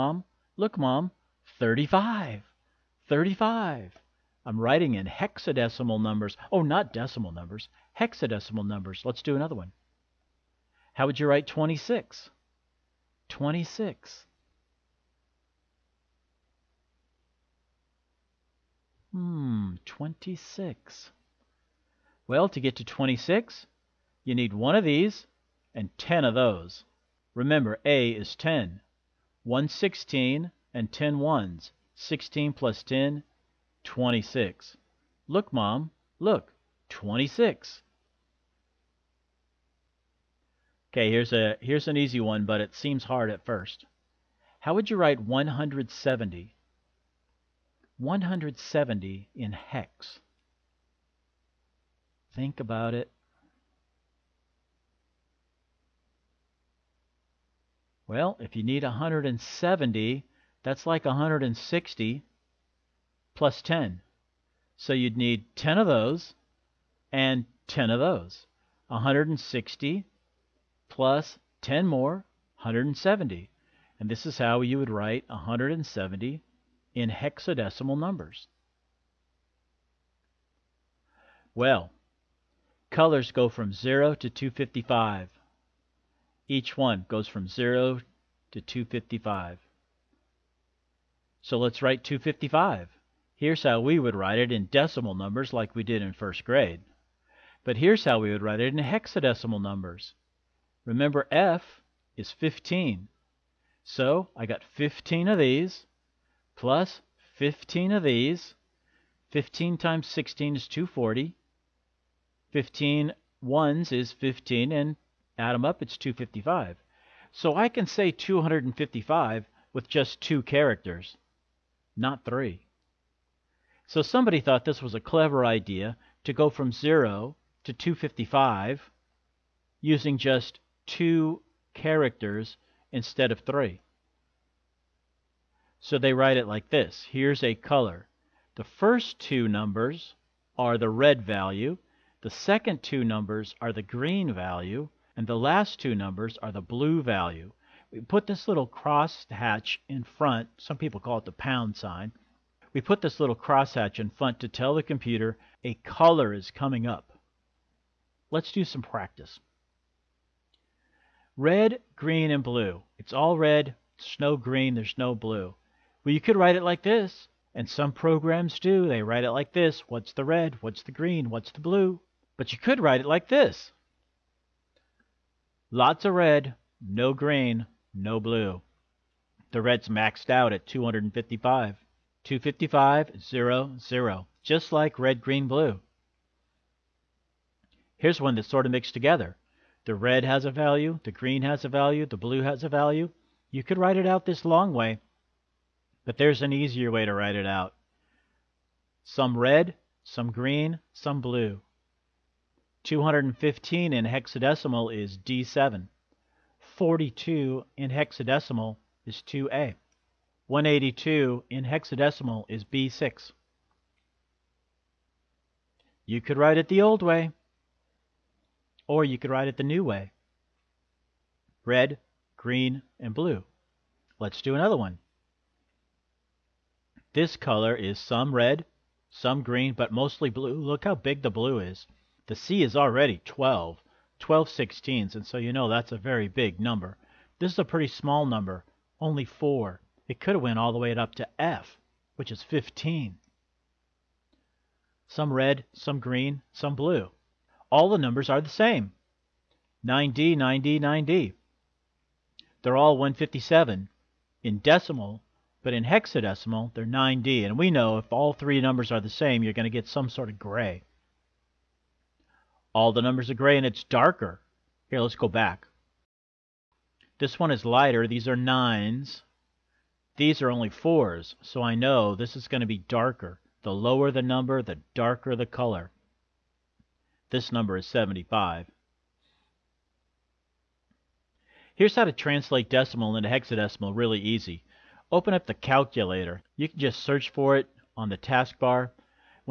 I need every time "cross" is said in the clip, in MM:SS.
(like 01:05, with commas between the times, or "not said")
02:28, 02:33.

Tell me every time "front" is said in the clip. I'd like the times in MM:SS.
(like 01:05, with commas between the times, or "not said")
02:30, 02:34.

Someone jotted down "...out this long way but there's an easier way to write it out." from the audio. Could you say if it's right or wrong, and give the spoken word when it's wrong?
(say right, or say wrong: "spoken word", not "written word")
right.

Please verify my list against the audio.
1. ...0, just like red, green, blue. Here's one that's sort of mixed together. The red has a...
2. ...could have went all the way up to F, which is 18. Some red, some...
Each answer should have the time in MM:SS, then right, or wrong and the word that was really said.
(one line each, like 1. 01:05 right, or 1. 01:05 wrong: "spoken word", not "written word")
1. 03:03 right
2. 04:00 wrong: "15", not "18".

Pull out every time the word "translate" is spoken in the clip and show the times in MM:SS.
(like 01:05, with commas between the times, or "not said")
04:42.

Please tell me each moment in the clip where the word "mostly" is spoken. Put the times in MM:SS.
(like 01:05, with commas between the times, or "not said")
03:49.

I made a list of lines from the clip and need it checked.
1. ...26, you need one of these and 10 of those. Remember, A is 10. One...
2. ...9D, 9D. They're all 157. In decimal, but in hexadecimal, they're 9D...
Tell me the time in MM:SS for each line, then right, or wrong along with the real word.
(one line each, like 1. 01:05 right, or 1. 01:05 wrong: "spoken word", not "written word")
1. 00:22 right
2. 04:10 right.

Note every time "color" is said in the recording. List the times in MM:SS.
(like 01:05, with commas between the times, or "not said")
01:22, 02:17, 02:35, 03:47, 04:35.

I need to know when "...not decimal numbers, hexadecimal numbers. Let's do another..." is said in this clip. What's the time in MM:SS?
00:06.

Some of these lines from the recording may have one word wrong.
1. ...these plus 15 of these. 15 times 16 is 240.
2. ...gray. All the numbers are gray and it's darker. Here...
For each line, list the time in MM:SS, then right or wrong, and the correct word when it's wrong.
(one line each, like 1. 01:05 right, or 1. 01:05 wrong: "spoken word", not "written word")
1. 01:45 right
2. 04:20 right.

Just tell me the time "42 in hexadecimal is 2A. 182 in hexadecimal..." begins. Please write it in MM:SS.
03:26.